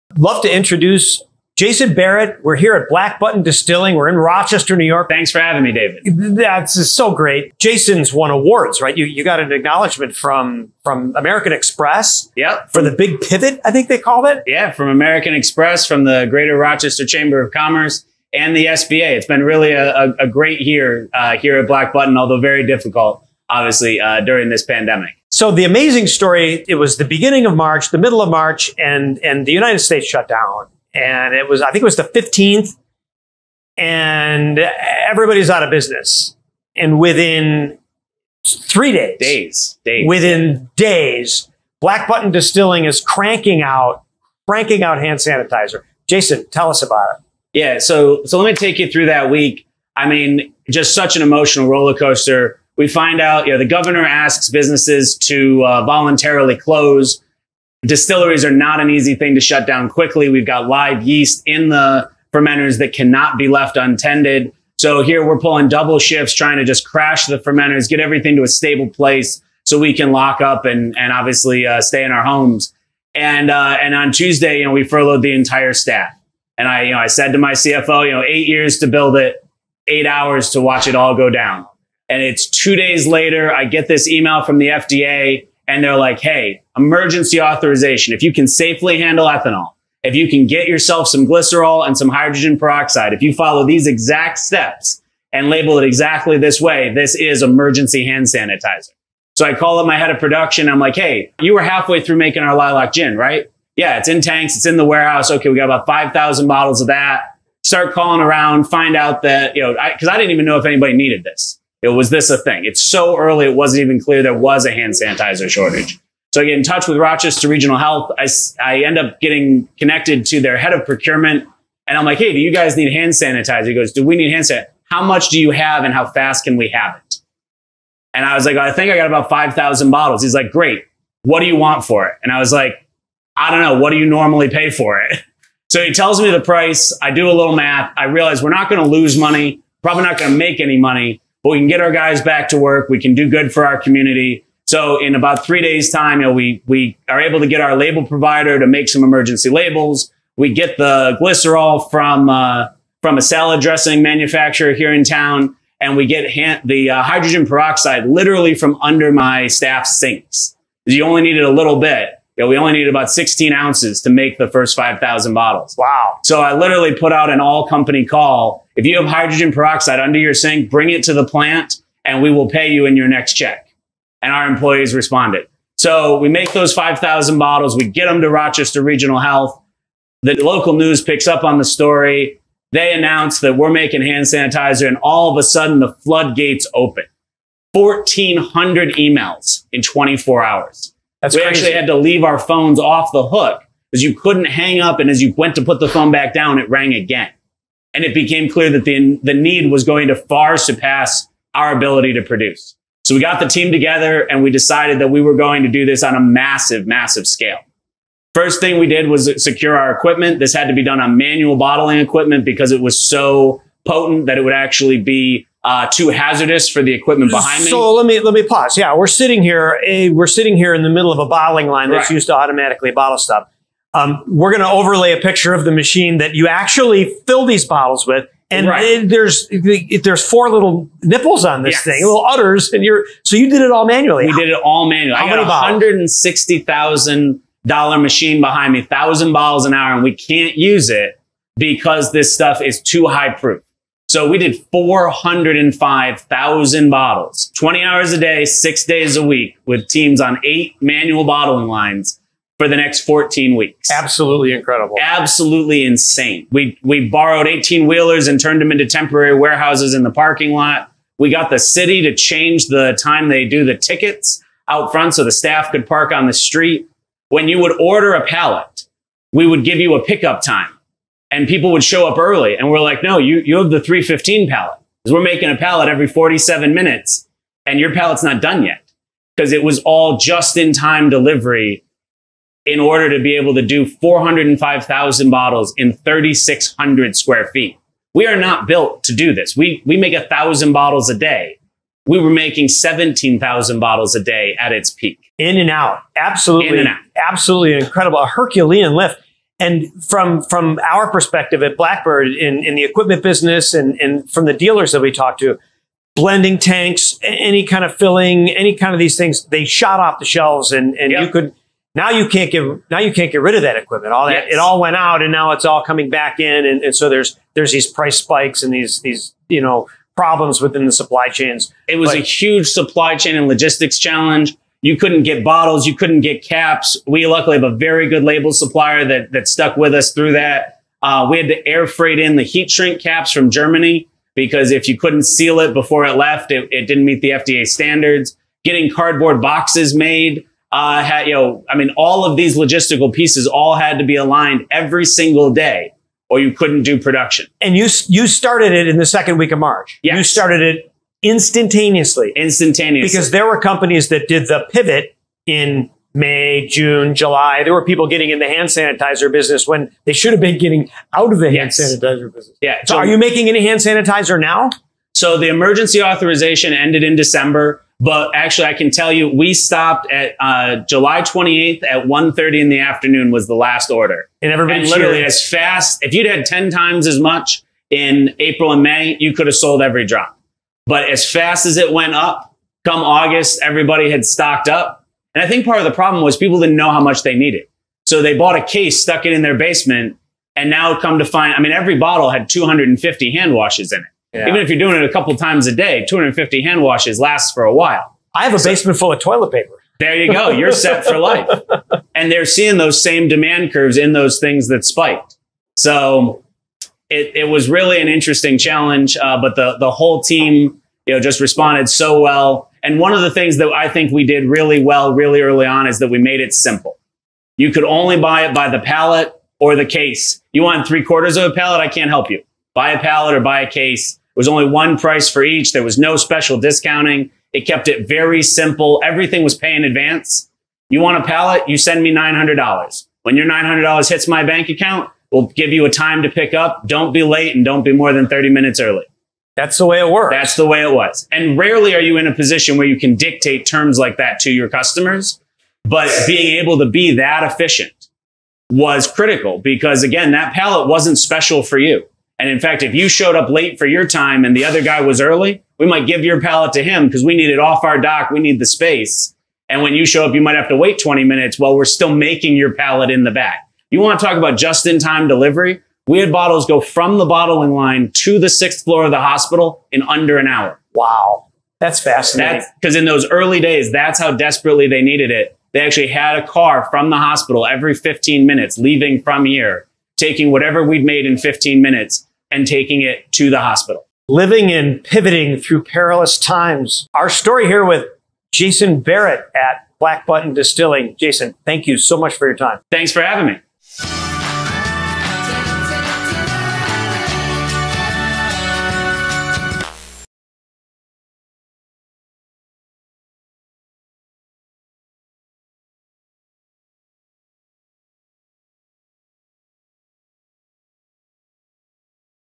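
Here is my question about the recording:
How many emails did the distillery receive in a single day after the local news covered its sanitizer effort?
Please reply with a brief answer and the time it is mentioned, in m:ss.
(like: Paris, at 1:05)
1,400, at 3:07.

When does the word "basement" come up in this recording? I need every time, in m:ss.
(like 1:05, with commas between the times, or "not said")
6:29, 6:38.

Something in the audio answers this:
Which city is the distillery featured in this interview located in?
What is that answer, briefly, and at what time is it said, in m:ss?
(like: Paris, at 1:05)
Rochester, New York, at 0:04.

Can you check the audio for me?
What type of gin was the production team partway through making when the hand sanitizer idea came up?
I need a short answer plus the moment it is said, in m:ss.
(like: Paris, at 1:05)
lilac gin, at 1:42.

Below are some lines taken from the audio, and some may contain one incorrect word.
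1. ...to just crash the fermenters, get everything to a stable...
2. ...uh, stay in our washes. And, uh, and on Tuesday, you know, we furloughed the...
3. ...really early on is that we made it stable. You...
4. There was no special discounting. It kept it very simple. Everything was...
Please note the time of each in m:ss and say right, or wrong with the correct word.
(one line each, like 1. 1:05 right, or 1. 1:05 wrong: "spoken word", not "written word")
1. 1:06 right
2. 1:11 wrong: "homes", not "washes"
3. 6:55 wrong: "simple", not "stable"
4. 7:05 right.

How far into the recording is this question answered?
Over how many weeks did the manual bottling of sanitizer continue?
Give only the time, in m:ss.
4:13.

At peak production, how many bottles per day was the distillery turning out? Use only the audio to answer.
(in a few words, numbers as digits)
17,000.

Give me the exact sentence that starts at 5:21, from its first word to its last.
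It was but, a huge supply chain and logistics challenge.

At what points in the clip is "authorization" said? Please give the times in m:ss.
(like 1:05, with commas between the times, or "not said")
1:27, 6:06.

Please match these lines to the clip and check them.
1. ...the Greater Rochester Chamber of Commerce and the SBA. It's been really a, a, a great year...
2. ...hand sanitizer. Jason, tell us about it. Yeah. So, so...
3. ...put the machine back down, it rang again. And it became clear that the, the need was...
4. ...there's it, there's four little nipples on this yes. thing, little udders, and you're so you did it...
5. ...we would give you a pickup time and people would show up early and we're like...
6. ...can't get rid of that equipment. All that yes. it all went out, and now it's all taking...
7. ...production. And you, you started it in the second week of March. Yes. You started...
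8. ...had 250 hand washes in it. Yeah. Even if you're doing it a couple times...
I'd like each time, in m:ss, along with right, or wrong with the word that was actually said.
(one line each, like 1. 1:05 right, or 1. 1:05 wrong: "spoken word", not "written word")
1. 0:16 right
2. 0:44 right
3. 3:15 wrong: "phone", not "machine"
4. 3:49 right
5. 4:29 right
6. 5:13 wrong: "coming", not "taking"
7. 5:46 right
8. 6:32 right.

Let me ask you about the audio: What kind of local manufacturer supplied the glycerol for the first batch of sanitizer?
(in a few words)
salad dressing manufacturer.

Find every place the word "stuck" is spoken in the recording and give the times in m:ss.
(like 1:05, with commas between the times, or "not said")
5:29, 6:28.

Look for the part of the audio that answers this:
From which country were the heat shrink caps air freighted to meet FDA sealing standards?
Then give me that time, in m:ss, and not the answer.
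5:33.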